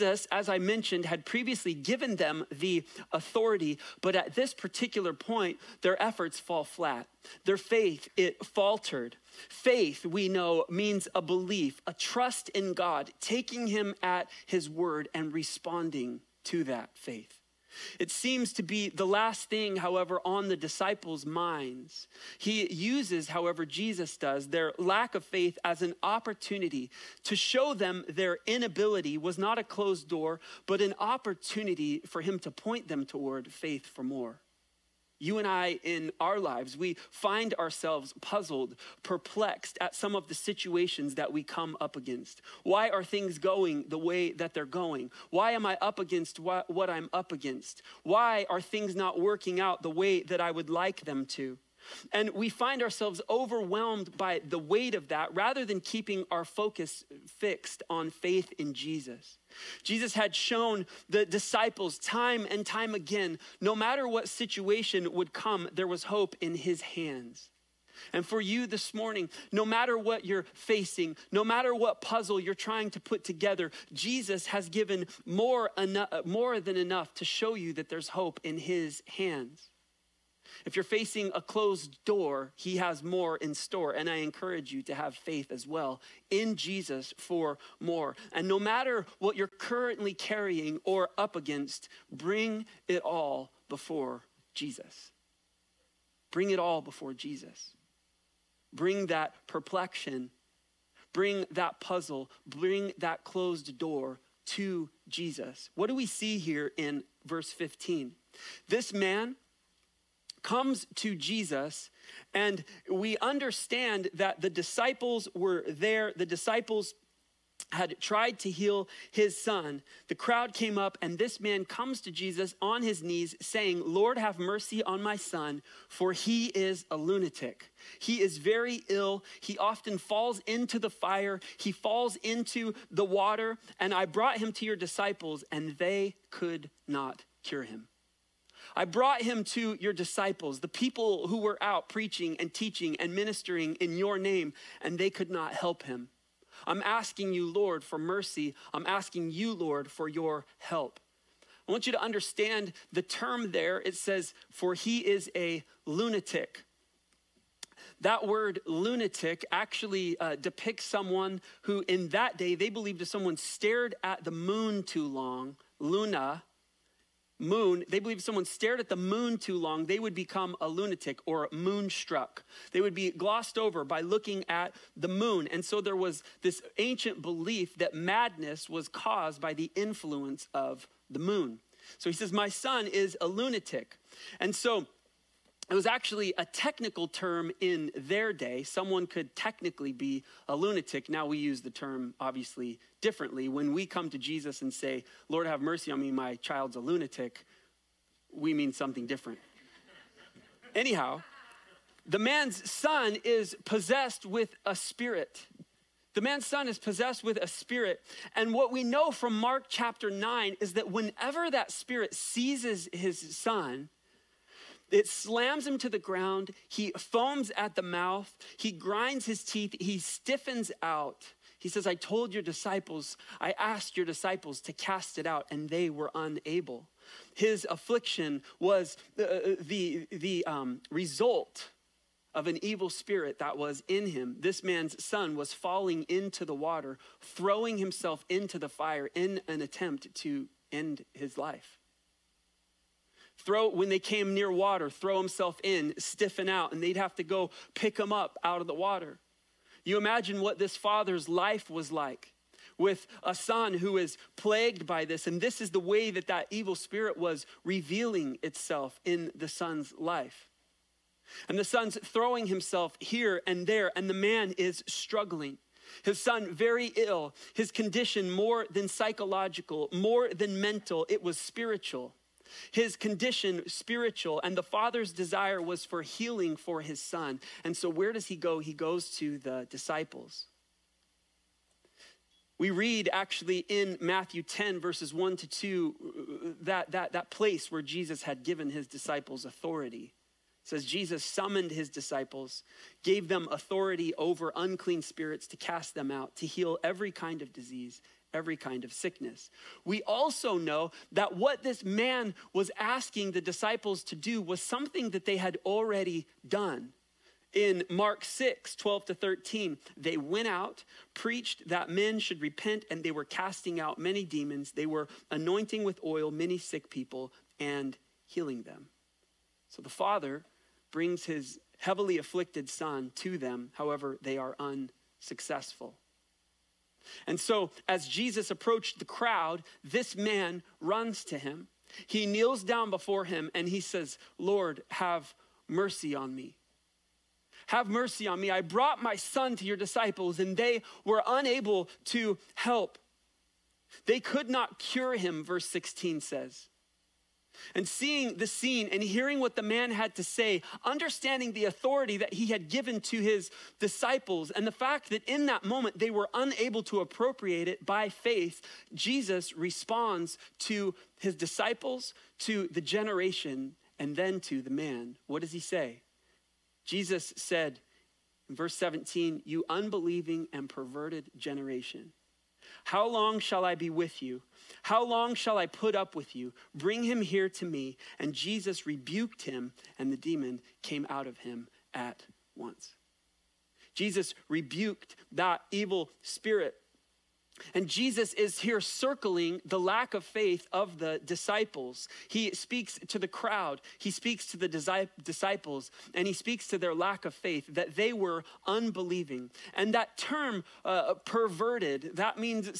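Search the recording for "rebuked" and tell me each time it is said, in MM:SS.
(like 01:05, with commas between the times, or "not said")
06:18, 06:24.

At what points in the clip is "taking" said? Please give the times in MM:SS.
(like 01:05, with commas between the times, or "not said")
00:13.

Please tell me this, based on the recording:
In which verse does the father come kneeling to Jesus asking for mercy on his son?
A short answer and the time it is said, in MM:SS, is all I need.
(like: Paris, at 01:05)
Verse 15, at 01:47.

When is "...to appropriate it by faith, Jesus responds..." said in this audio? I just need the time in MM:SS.
05:56.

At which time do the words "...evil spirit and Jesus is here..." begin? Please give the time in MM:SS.
06:25.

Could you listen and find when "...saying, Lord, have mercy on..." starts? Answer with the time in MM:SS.
02:03.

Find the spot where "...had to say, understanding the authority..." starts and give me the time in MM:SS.
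05:49.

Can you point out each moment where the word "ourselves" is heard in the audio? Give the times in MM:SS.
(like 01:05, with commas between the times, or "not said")
00:37, 00:52.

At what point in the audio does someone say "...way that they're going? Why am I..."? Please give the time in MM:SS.
00:43.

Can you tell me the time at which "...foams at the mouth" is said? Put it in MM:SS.
03:36.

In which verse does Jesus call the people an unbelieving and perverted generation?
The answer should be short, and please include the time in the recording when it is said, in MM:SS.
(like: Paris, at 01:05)
Verse 17, at 06:08.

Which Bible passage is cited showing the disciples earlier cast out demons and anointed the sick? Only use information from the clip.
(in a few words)
Mark 6:12-13.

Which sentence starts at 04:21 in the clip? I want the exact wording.
And the son's throwing himself here and there, and the man is struggling.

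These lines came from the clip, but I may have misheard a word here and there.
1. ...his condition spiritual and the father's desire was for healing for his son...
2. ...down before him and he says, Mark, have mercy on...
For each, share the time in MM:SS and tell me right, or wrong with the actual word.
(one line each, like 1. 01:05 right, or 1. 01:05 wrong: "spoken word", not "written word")
1. 04:32 right
2. 05:32 wrong: "Lord", not "Mark".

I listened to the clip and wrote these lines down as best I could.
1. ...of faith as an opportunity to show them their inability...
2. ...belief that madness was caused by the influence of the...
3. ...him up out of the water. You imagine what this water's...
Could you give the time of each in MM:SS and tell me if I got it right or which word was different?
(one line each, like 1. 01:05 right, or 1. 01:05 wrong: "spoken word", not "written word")
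1. 00:25 right
2. 02:57 right
3. 04:07 wrong: "father", not "water".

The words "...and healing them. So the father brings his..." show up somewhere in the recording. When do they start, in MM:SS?
05:17.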